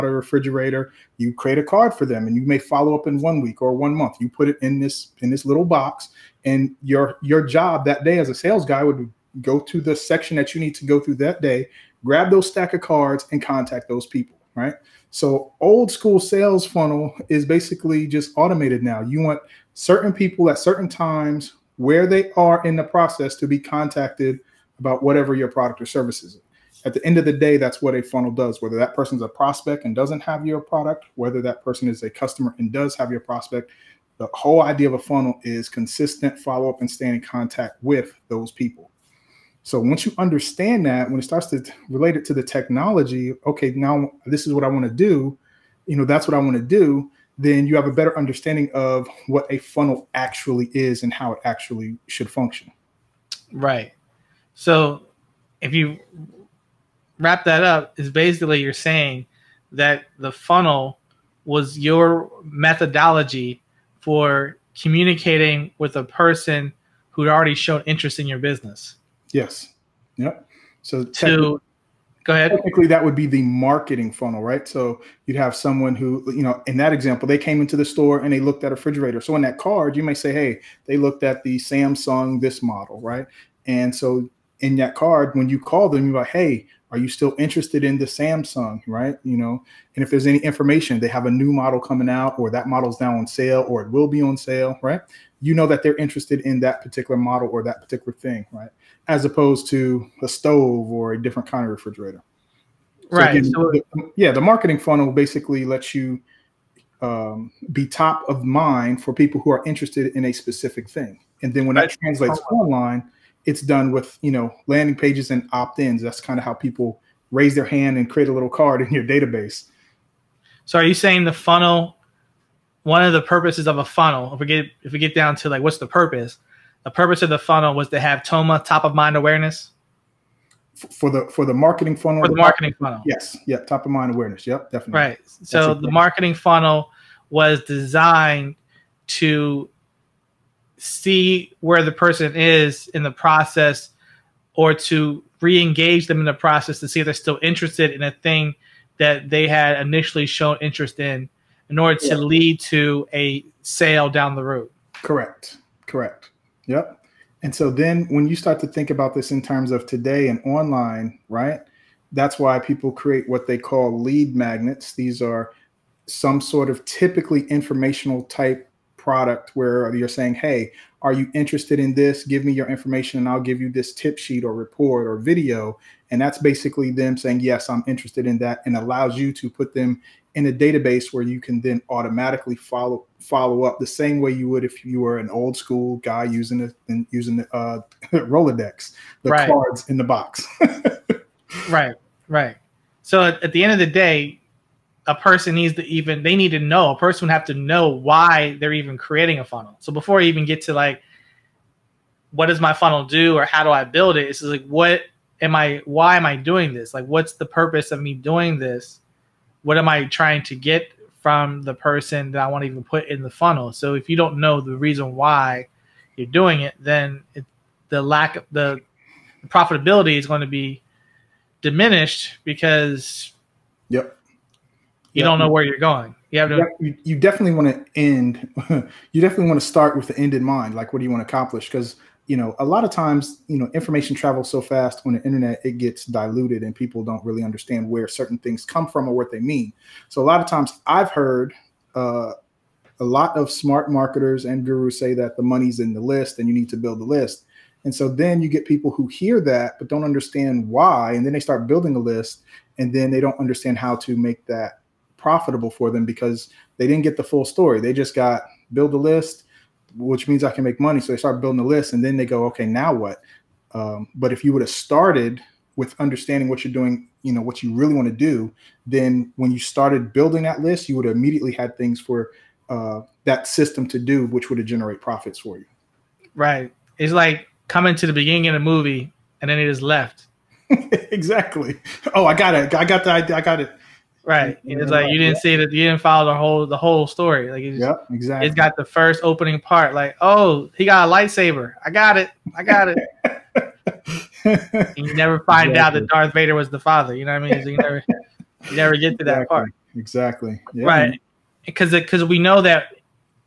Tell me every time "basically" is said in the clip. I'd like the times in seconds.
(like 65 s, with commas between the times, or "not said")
17 s, 58 s, 105 s, 176 s.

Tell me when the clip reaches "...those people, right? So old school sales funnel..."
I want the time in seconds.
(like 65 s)
13 s.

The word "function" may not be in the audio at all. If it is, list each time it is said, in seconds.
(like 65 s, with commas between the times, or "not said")
52 s.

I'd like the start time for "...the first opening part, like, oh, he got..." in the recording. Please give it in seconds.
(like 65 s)
288 s.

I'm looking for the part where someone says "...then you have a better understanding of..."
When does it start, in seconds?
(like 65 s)
47 s.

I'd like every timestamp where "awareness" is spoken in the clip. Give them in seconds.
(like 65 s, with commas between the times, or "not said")
129 s, 134 s.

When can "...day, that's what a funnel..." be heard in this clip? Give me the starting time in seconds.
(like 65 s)
27 s.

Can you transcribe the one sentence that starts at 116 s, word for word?
That's kind of how people raise their hand and create a little card in your database.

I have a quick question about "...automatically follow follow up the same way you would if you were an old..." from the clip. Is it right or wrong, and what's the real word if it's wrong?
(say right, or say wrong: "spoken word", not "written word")
right.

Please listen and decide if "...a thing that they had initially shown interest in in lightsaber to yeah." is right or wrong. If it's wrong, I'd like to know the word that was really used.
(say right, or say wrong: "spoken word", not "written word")
wrong: "order", not "lightsaber".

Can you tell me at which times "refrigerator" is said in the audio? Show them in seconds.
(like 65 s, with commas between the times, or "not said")
0 s, 78 s, 101 s.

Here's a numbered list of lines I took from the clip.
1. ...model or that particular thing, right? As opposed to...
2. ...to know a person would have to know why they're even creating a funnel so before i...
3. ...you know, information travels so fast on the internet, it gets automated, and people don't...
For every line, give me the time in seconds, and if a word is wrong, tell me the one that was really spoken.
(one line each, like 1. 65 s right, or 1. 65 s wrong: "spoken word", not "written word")
1. 97 s right
2. 196 s right
3. 233 s wrong: "diluted", not "automated".